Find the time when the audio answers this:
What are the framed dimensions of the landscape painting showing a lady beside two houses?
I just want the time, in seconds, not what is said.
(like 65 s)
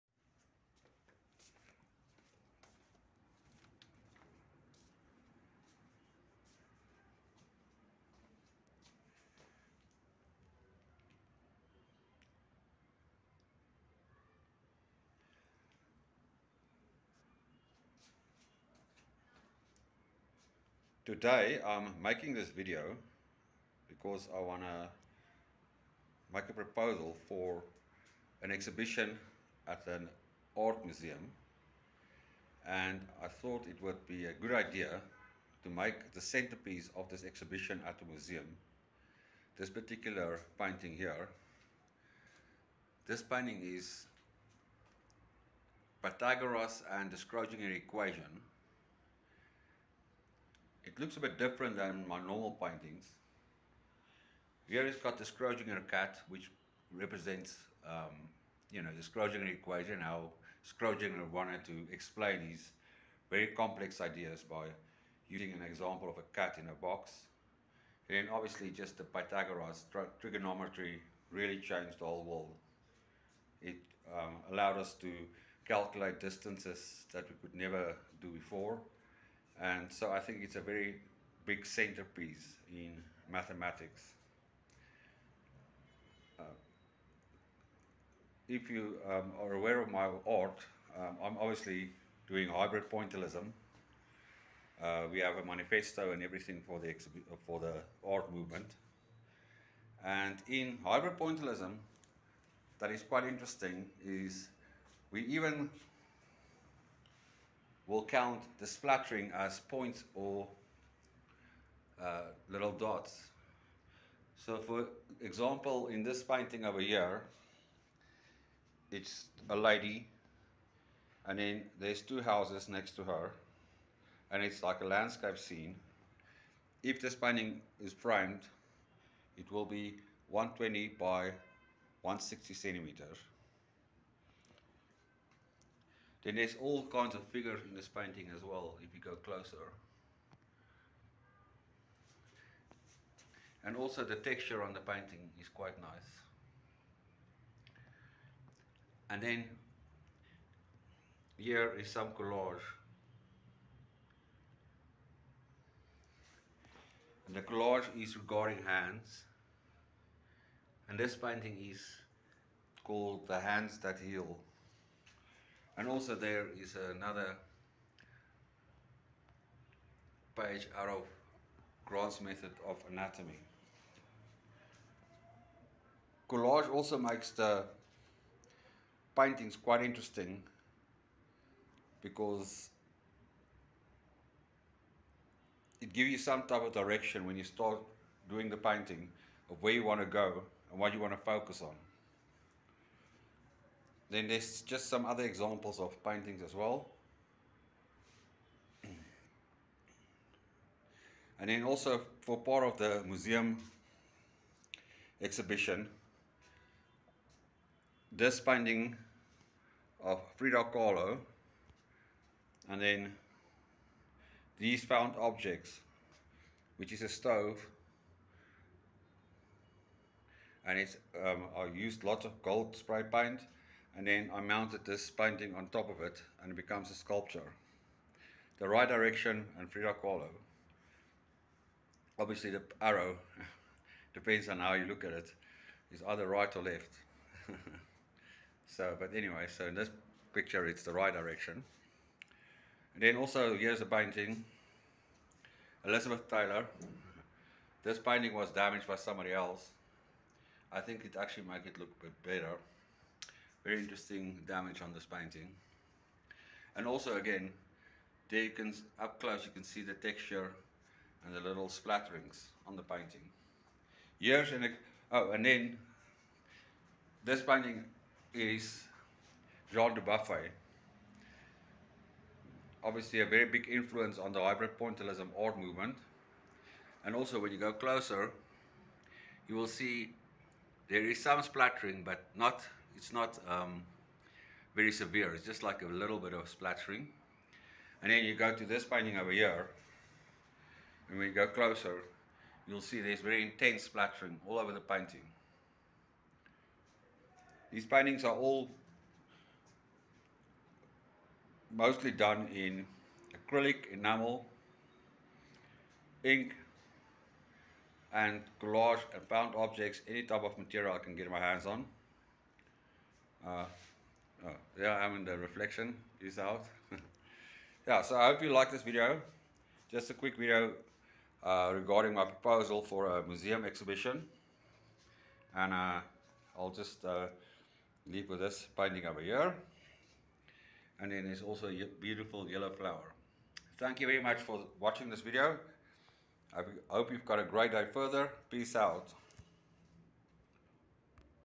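130 s.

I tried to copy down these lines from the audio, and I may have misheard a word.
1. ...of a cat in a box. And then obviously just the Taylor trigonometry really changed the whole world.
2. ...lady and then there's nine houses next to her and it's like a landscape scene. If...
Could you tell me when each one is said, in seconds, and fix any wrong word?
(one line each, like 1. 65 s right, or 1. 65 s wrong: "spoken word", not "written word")
1. 66 s wrong: "Pythagoras", not "Taylor"
2. 119 s wrong: "two", not "nine".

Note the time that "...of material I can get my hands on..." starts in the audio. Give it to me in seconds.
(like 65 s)
310 s.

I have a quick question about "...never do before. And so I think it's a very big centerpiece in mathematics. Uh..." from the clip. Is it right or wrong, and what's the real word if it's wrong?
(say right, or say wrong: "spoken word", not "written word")
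right.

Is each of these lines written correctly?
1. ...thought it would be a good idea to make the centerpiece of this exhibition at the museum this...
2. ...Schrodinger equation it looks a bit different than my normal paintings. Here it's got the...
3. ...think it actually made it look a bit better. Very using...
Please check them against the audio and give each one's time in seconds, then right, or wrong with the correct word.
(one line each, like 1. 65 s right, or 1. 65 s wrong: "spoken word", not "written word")
1. 33 s right
2. 47 s right
3. 250 s wrong: "interesting", not "using".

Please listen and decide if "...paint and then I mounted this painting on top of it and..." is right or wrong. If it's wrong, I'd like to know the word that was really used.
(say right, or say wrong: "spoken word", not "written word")
right.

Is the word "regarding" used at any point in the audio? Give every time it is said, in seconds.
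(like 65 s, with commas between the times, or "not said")
158 s, 321 s.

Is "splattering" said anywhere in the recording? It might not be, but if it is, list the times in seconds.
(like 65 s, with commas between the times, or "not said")
108 s, 261 s, 281 s, 286 s, 293 s.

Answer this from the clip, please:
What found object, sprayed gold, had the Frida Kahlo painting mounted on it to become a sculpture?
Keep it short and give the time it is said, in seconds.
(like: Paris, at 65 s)
a stove, at 217 s.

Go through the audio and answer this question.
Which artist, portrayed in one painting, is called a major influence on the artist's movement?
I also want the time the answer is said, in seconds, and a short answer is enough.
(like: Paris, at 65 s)
Jean Dubuffet, at 269 s.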